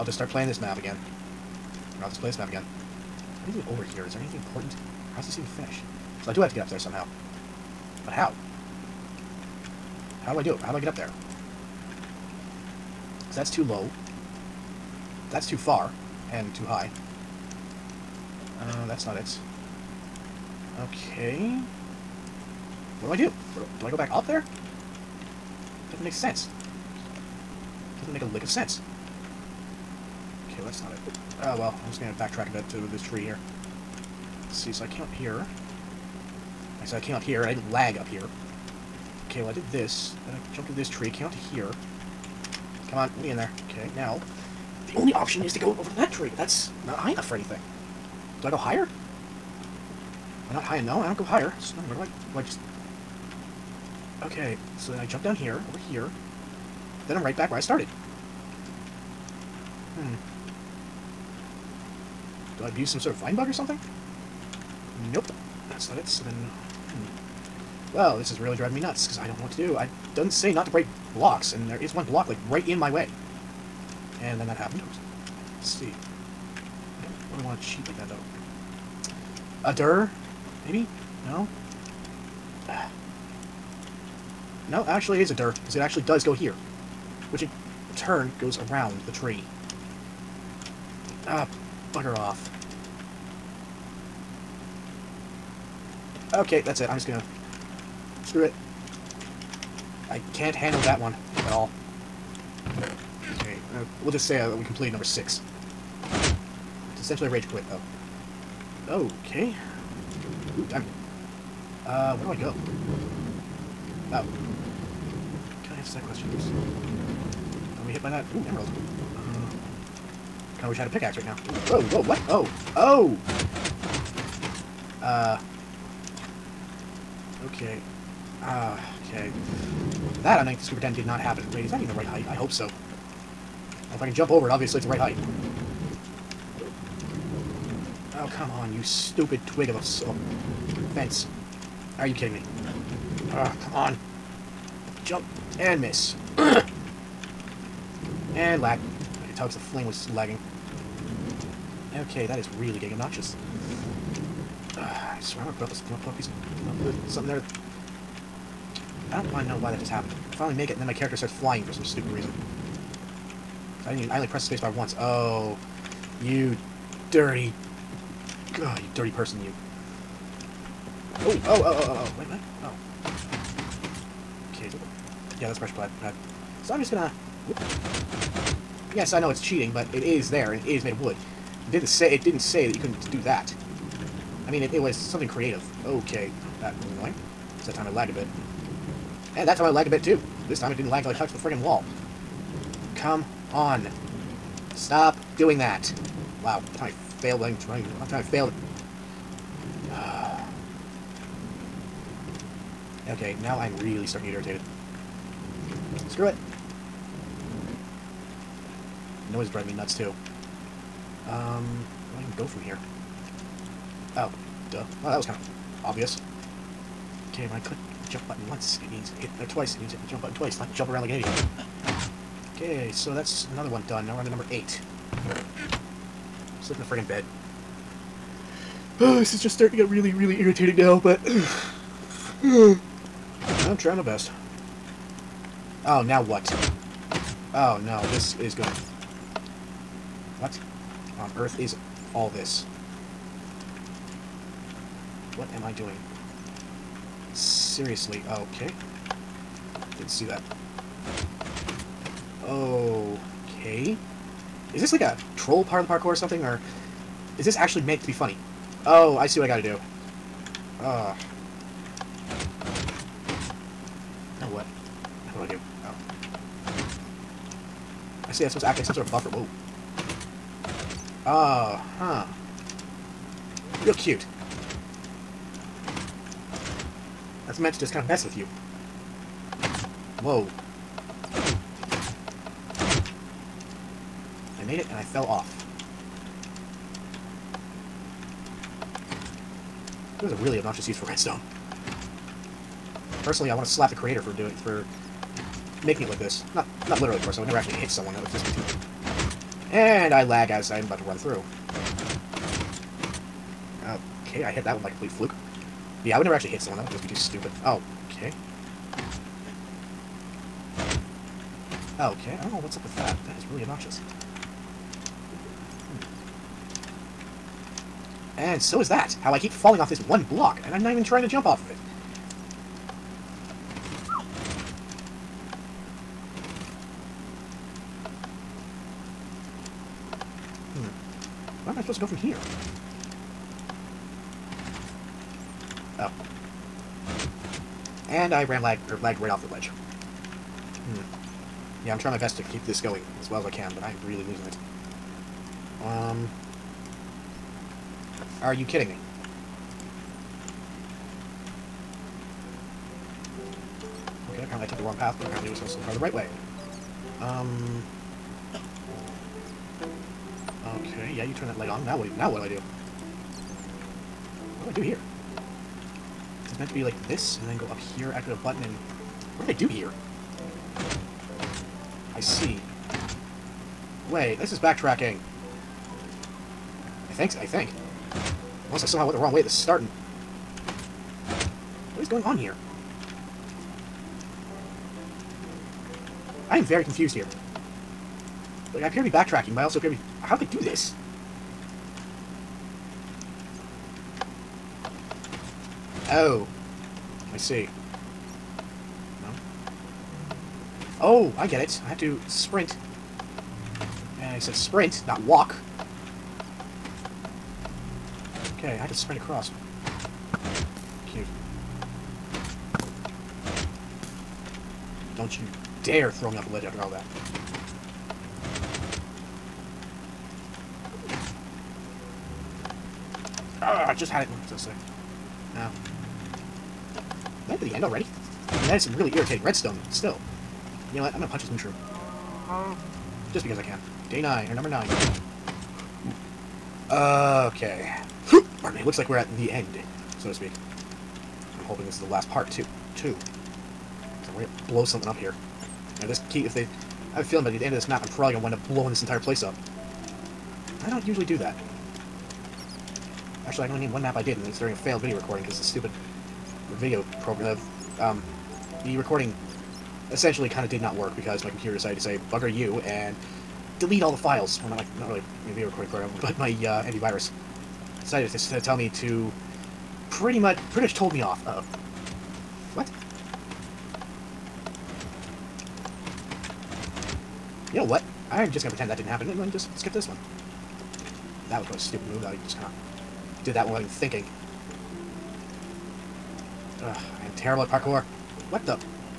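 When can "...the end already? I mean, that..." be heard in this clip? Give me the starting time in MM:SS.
07:07.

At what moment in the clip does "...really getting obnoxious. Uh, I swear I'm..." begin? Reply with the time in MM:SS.
02:32.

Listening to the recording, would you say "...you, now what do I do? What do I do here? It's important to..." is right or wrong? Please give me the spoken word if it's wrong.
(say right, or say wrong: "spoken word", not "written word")
wrong: "meant", not "important".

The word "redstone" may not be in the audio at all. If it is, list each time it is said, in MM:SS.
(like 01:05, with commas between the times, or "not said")
04:51, 07:09.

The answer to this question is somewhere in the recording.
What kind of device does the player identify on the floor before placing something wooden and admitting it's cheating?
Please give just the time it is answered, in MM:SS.
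02:55.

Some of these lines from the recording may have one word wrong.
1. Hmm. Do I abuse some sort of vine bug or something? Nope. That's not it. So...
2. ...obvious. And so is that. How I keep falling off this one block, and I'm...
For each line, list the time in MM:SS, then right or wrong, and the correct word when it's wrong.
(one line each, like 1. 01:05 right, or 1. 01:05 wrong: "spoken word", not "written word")
1. 00:59 right
2. 05:13 wrong: "obnoxious", not "obvious".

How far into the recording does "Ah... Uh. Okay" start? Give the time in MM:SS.
02:08.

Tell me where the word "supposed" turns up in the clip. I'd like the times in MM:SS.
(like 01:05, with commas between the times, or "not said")
04:28, 05:31.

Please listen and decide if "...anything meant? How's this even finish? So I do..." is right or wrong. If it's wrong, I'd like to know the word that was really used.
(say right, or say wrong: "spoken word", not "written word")
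wrong: "important", not "meant".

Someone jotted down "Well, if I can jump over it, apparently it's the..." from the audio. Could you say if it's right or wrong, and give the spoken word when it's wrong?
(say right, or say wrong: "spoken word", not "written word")
wrong: "obviously", not "apparently".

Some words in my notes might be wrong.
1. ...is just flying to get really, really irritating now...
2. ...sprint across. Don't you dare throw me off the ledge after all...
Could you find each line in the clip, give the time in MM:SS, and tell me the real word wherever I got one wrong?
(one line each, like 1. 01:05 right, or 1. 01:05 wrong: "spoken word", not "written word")
1. 03:49 wrong: "starting", not "flying"
2. 06:48 right.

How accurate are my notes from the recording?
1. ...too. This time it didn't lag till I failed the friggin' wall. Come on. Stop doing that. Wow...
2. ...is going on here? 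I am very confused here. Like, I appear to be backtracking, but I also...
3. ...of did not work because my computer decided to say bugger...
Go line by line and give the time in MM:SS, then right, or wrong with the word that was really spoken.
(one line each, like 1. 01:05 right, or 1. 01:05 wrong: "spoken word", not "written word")
1. 03:10 wrong: "touched", not "failed"
2. 06:22 right
3. 07:40 right.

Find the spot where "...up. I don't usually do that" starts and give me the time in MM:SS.
07:29.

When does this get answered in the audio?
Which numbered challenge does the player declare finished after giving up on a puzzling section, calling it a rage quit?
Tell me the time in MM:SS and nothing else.
01:44.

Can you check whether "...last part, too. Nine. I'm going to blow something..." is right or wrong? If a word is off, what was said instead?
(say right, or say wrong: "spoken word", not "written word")
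wrong: "Two", not "Nine".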